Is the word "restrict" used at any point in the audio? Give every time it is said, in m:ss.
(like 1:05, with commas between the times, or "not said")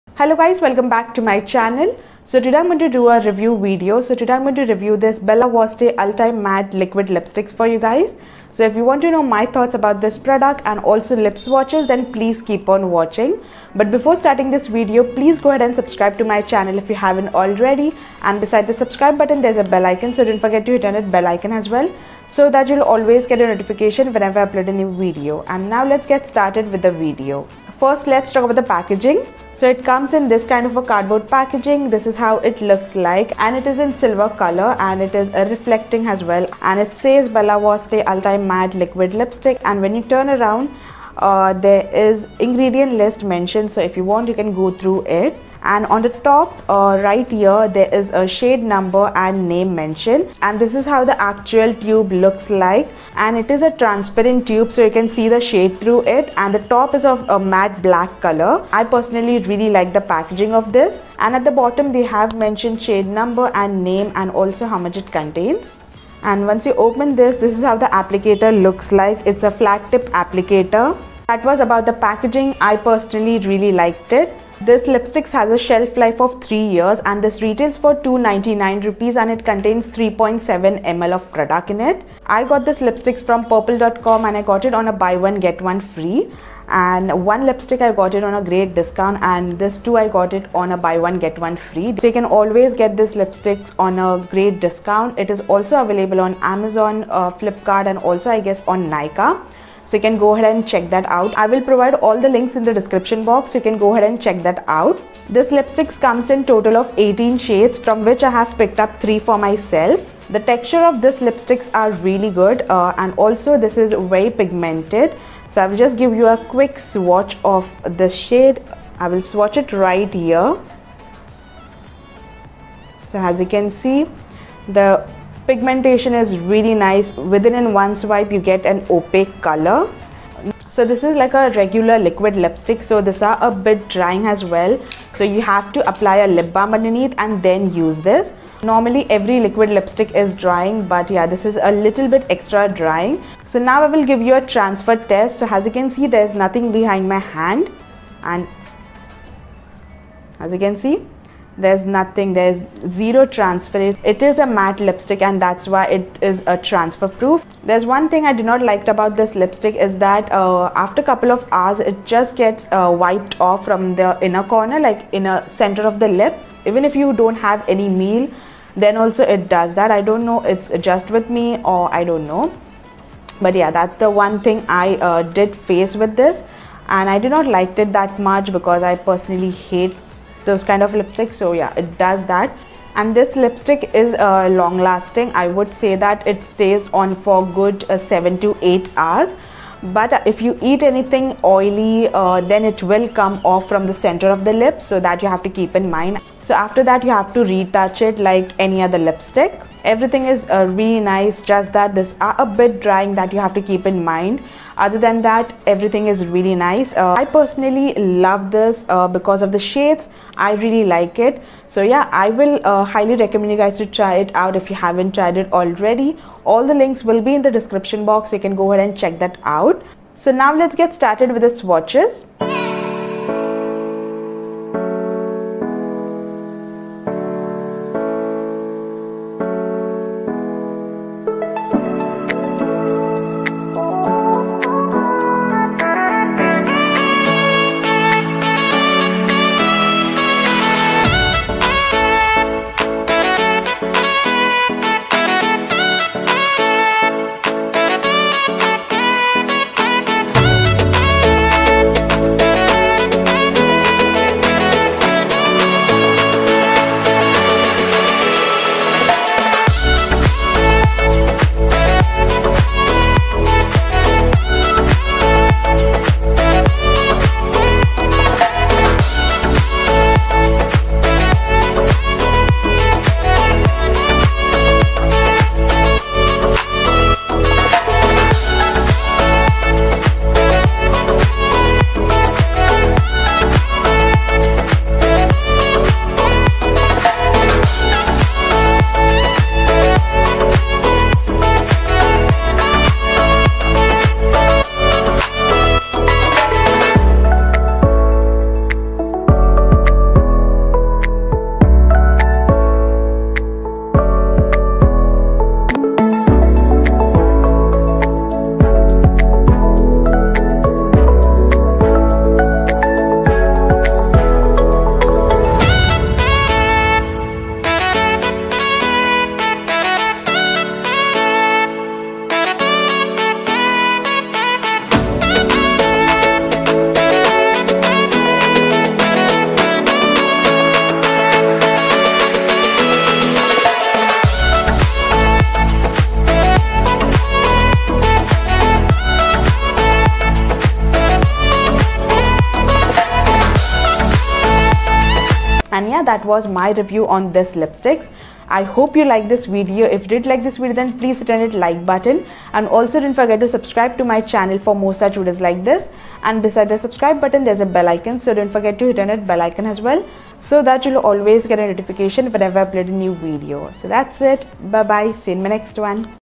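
not said.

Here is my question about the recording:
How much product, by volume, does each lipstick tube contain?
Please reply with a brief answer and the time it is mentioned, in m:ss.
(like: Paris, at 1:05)
3.7 ml, at 1:19.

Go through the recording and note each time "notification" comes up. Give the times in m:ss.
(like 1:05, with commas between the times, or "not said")
0:23, 6:01.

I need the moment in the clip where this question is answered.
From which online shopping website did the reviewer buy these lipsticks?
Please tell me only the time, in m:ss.
1:23.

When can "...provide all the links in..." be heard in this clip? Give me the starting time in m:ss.
1:41.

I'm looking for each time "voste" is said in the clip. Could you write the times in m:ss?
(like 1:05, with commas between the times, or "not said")
0:05, 0:37.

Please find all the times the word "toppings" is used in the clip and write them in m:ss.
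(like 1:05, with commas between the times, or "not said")
not said.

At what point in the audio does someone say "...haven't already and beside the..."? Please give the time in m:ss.
0:17.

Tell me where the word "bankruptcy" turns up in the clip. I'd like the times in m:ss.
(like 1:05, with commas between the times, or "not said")
not said.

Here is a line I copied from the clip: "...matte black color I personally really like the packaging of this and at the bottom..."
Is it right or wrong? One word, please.
right.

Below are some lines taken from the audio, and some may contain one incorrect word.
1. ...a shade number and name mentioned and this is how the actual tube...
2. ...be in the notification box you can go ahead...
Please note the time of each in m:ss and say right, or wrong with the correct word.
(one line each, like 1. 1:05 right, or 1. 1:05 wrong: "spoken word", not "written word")
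1. 0:48 right
2. 3:37 wrong: "description", not "notification".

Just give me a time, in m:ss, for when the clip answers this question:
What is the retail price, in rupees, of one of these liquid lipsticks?
1:18.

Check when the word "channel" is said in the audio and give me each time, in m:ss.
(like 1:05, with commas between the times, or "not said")
0:01, 0:16, 5:54.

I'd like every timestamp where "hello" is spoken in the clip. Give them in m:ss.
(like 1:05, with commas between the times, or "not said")
0:00.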